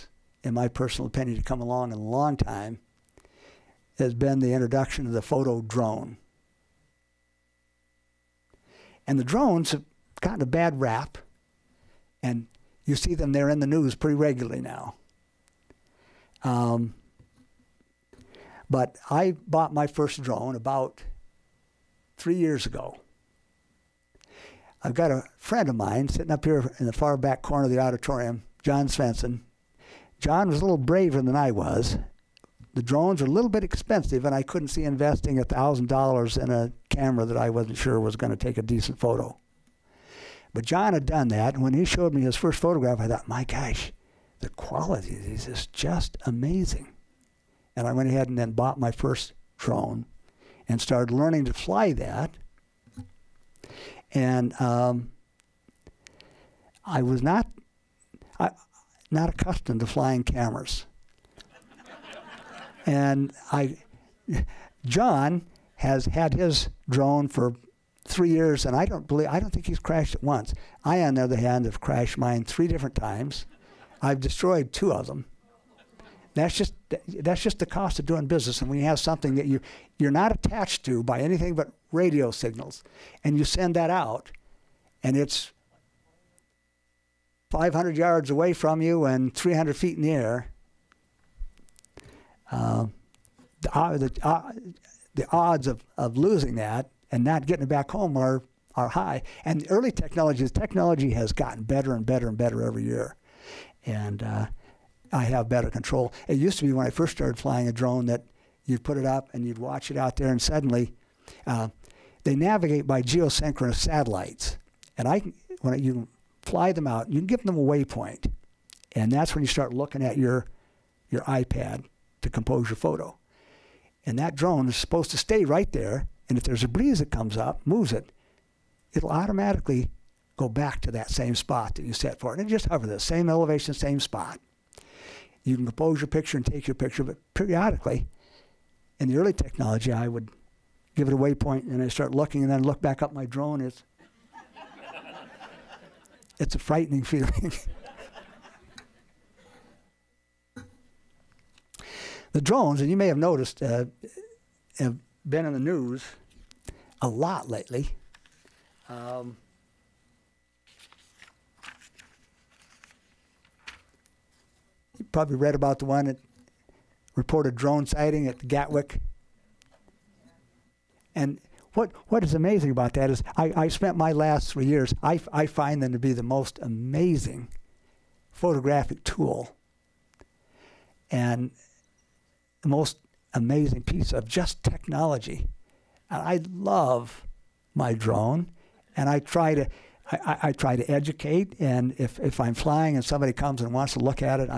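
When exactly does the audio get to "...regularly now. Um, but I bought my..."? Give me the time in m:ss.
0:14.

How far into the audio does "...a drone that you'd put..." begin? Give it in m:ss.
1:47.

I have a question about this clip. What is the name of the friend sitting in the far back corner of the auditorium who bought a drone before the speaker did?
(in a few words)
John Svensson.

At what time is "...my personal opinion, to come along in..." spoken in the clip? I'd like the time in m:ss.
0:00.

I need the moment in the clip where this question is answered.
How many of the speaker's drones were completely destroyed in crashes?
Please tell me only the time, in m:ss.
1:14.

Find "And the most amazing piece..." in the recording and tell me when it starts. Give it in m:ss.
3:01.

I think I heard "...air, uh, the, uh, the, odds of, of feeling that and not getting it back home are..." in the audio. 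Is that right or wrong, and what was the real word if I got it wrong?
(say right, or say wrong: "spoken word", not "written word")
wrong: "losing", not "feeling".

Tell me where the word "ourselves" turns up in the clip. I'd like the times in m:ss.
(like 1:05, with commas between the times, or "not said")
not said.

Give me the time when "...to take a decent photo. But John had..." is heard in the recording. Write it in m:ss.
0:38.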